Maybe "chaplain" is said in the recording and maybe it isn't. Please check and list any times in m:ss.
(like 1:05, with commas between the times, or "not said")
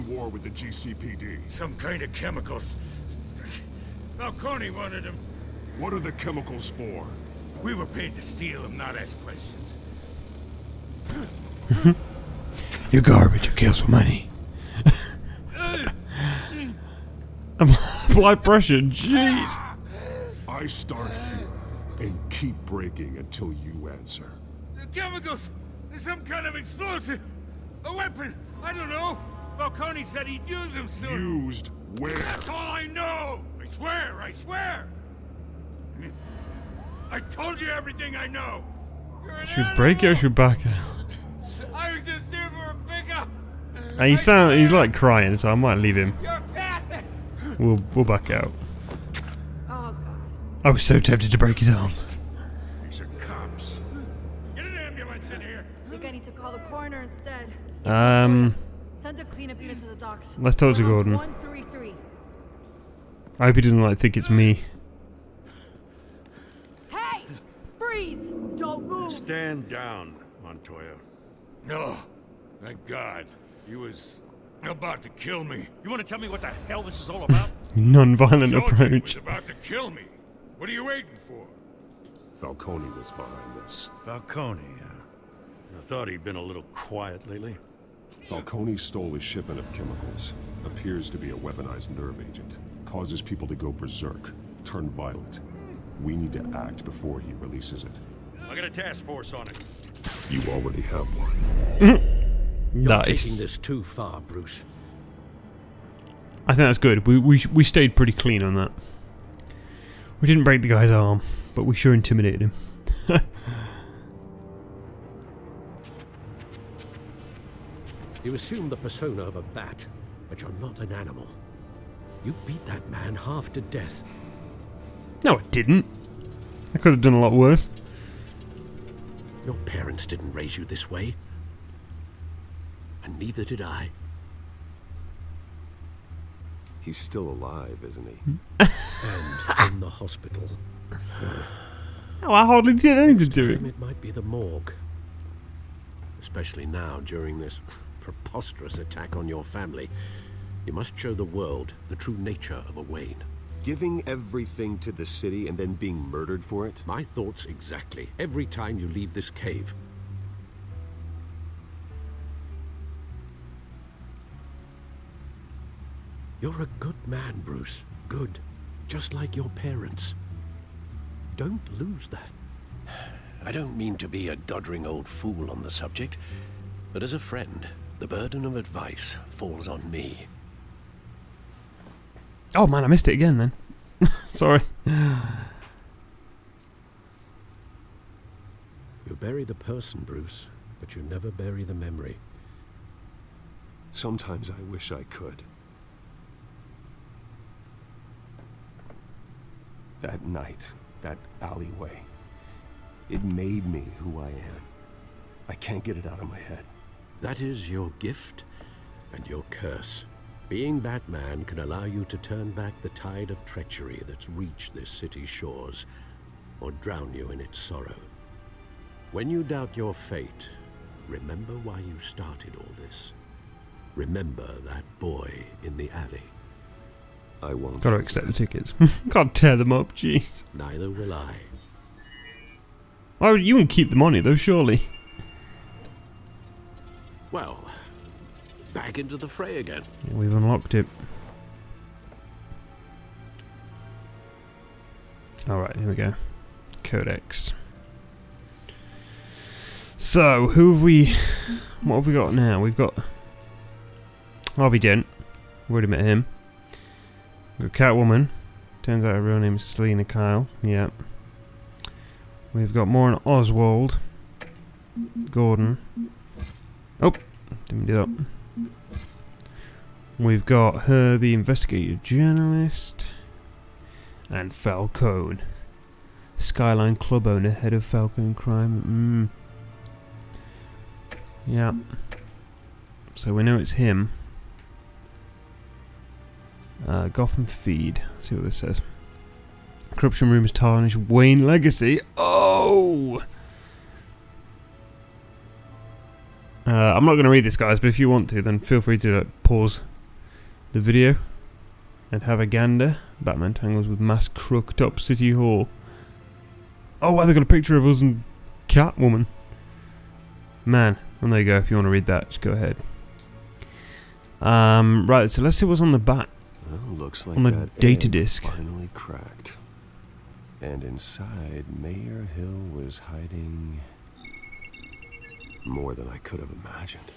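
not said.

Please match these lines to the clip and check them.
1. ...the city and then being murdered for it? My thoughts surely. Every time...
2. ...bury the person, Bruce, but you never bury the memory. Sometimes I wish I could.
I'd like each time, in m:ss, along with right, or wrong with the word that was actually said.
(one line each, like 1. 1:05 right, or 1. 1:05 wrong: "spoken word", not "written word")
1. 2:34 wrong: "exactly", not "surely"
2. 3:09 right.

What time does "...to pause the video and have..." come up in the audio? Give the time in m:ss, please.
4:58.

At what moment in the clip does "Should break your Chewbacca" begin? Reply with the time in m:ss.
0:39.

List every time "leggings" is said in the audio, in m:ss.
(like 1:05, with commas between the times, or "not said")
not said.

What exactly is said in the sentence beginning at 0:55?
I think I need to call the coroner instead.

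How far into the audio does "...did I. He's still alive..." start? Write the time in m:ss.
2:13.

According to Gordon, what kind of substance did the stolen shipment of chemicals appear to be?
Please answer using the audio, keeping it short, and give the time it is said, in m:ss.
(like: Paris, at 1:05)
Weaponized nerve agent, at 1:31.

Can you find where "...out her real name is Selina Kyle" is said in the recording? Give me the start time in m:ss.
4:19.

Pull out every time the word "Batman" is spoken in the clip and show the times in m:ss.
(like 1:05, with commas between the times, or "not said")
3:30, 5:03.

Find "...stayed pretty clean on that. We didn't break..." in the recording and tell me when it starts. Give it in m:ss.
1:47.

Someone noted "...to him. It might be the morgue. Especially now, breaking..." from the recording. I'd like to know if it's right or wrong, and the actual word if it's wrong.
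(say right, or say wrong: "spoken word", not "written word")
wrong: "during", not "breaking".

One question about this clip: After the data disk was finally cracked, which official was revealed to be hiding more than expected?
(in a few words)
Mayor Hill.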